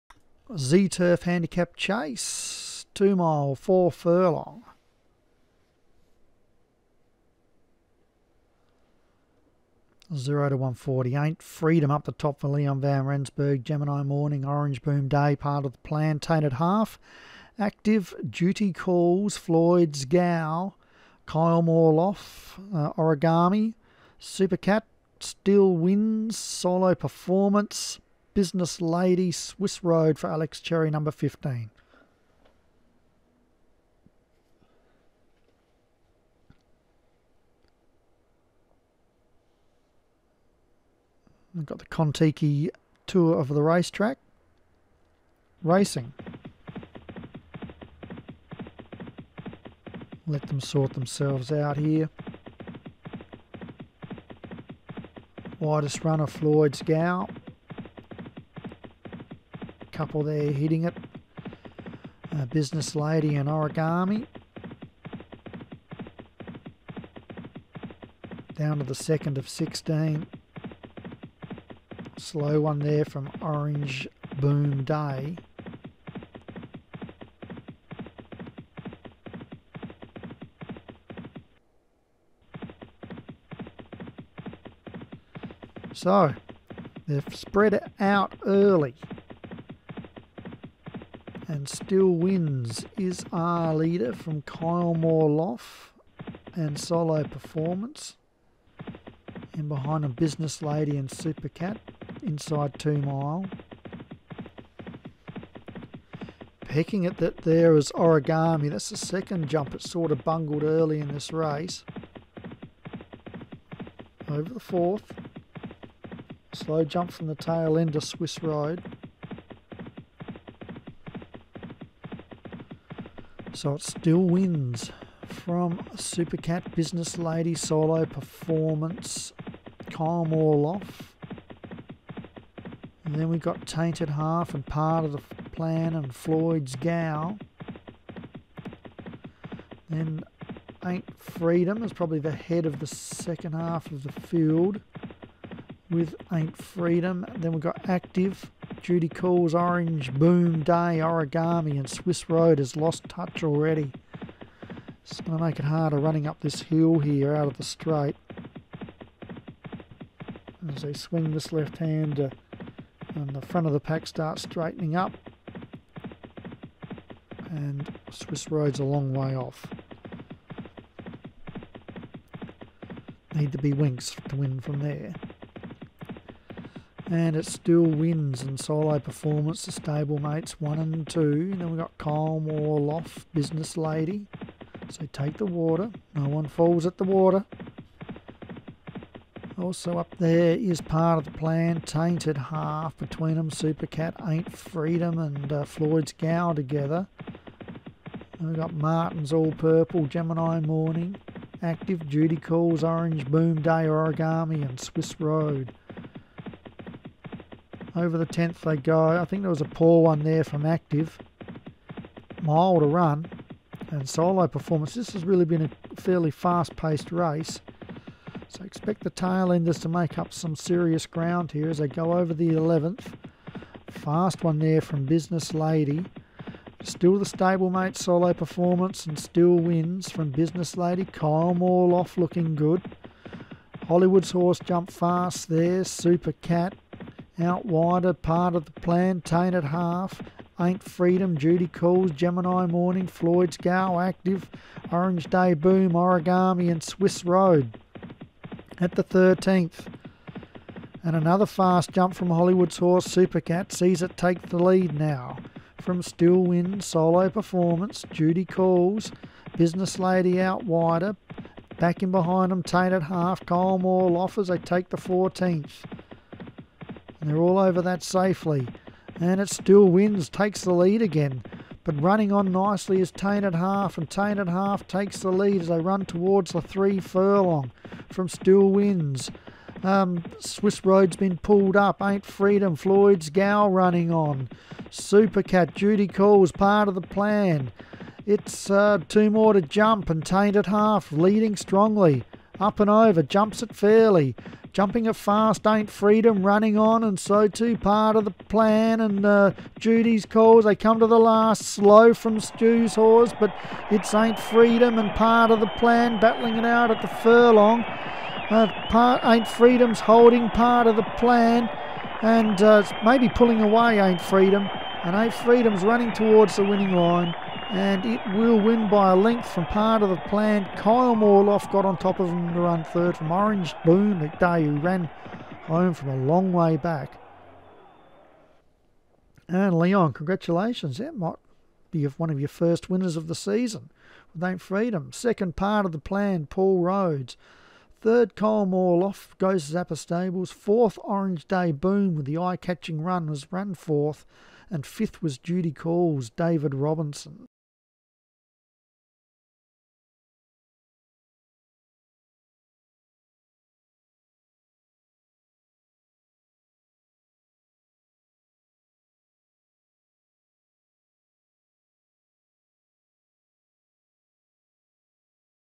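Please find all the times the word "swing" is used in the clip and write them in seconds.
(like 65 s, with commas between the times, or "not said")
160 s.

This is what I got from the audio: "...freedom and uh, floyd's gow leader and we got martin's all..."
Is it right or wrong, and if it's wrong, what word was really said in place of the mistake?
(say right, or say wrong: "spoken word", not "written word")
wrong: "together", not "leader".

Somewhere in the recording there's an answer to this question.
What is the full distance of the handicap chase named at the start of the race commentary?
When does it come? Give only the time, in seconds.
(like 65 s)
2 s.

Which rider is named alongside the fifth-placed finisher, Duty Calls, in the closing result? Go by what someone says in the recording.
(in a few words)
David Robinson.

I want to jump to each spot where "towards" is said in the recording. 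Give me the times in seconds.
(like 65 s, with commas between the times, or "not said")
276 s, 316 s.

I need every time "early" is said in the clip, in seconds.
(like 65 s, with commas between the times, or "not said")
88 s, 110 s.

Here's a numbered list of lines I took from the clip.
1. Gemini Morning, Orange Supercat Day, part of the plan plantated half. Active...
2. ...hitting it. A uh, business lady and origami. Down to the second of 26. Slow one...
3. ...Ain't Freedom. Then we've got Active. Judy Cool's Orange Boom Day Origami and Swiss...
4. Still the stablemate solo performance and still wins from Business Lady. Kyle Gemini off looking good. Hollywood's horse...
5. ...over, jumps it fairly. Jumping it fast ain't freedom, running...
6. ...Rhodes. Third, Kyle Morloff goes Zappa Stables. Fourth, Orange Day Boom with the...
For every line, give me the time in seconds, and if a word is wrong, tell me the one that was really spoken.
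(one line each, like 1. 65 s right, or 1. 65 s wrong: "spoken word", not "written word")
1. 13 s wrong: "Boom", not "Supercat"
2. 60 s wrong: "16", not "26"
3. 146 s right
4. 226 s wrong: "Moore", not "Gemini"
5. 292 s right
6. 336 s right.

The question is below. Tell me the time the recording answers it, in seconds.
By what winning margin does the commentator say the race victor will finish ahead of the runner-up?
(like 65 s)
319 s.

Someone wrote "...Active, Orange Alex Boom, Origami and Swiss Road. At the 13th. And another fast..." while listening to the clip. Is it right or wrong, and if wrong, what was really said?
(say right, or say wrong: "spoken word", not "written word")
wrong: "Day", not "Alex".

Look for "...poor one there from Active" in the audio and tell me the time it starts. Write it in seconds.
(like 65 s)
209 s.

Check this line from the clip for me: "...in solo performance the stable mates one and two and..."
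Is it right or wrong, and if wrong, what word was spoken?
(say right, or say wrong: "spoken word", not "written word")
right.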